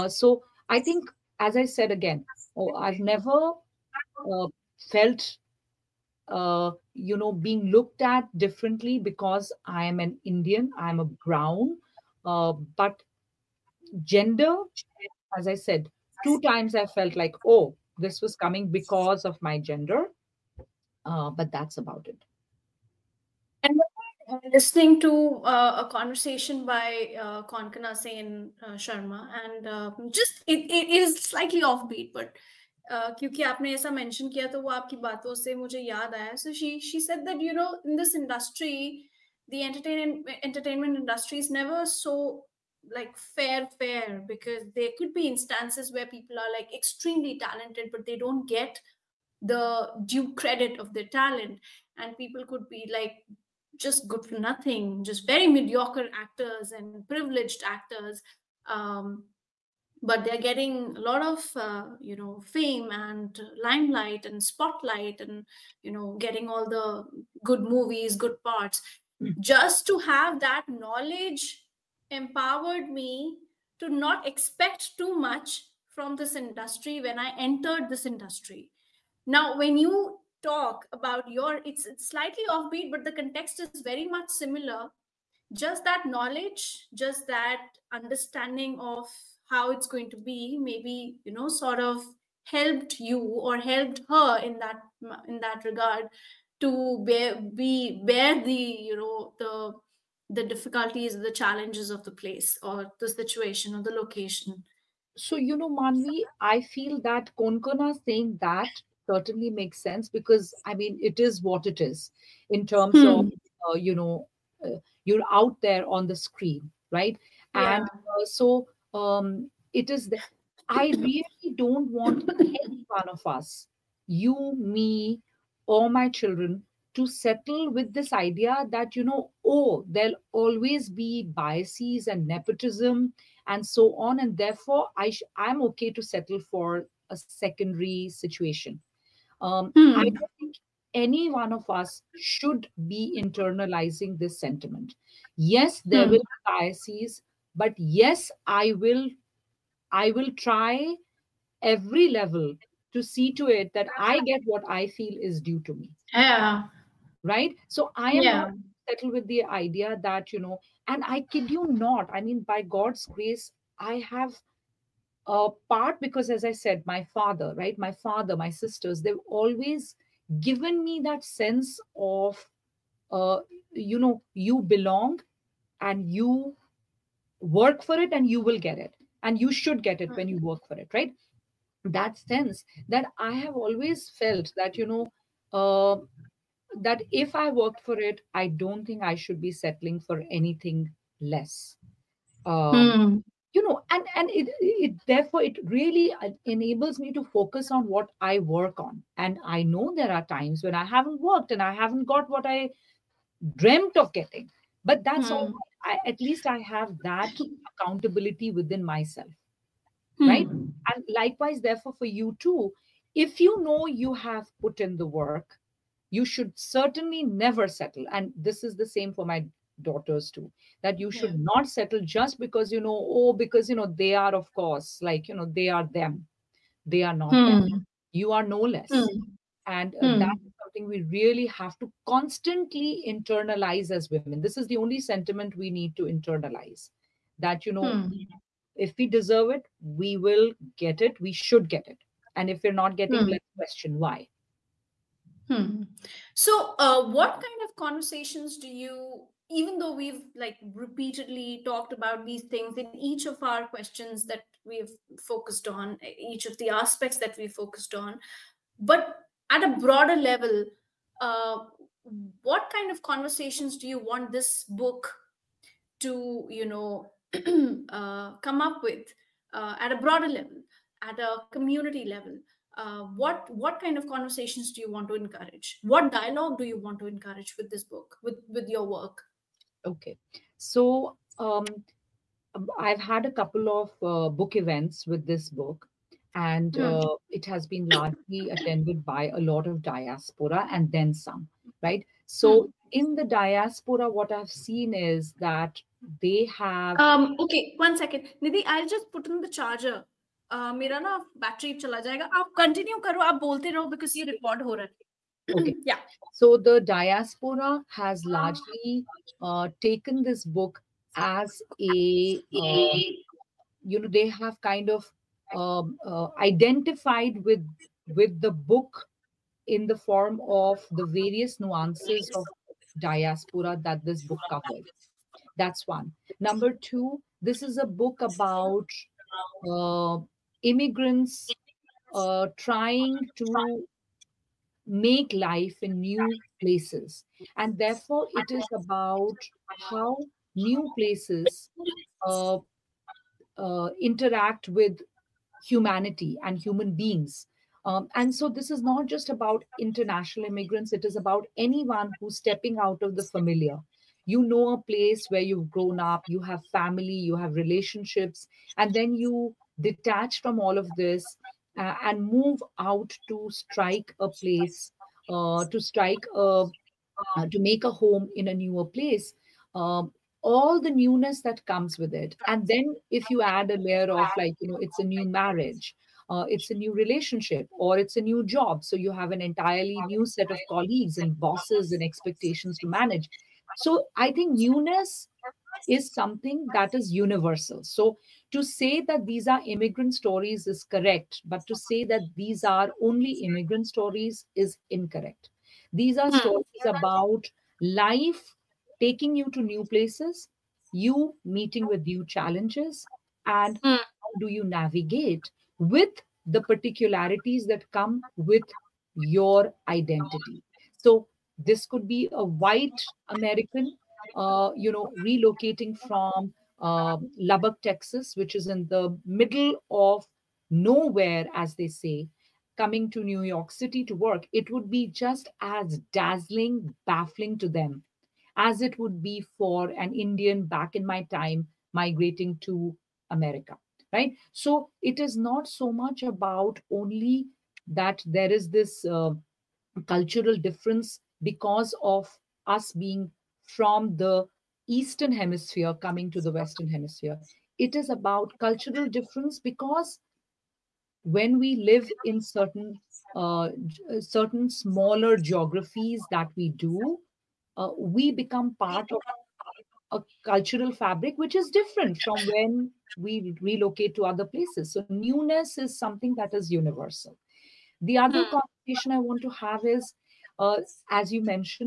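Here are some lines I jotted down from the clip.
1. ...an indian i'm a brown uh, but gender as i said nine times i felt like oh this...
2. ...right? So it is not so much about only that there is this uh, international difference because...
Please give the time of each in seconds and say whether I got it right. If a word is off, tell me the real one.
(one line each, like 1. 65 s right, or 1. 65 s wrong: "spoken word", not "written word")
1. 9 s wrong: "two", not "nine"
2. 434 s wrong: "cultural", not "international".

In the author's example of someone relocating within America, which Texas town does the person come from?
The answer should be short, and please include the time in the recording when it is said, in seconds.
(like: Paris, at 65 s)
Lubbock, at 417 s.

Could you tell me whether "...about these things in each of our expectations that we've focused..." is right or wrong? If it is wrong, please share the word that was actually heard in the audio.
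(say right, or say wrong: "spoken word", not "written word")
wrong: "questions", not "expectations".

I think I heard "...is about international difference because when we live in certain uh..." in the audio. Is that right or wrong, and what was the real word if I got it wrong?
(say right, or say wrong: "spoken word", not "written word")
wrong: "cultural", not "international".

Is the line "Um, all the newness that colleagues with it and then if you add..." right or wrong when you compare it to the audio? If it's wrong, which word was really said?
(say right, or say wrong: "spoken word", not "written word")
wrong: "comes", not "colleagues".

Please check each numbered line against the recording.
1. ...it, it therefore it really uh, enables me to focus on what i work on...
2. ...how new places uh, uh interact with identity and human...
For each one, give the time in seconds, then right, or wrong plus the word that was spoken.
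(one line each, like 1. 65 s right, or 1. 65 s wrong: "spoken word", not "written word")
1. 194 s right
2. 339 s wrong: "humanity", not "identity".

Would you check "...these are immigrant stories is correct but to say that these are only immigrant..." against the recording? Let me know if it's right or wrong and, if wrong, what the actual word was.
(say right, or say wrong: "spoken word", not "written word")
right.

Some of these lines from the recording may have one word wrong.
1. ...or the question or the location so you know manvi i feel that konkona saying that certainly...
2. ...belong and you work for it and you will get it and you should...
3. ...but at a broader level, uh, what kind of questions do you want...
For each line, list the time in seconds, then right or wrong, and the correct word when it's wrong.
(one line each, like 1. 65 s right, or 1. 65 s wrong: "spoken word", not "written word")
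1. 102 s wrong: "situation", not "question"
2. 174 s right
3. 258 s wrong: "conversations", not "questions".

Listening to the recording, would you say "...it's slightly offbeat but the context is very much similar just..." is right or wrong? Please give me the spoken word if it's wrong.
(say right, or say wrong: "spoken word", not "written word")
right.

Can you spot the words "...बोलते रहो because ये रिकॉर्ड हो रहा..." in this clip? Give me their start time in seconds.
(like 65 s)
303 s.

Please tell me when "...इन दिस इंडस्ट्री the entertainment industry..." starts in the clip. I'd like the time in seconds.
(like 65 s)
37 s.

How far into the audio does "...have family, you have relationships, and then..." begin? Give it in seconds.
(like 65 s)
356 s.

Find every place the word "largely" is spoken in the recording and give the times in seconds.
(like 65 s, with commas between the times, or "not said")
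287 s, 308 s.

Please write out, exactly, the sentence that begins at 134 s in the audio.
And therefore, I sh- I'm okay to settle for a secondary situation.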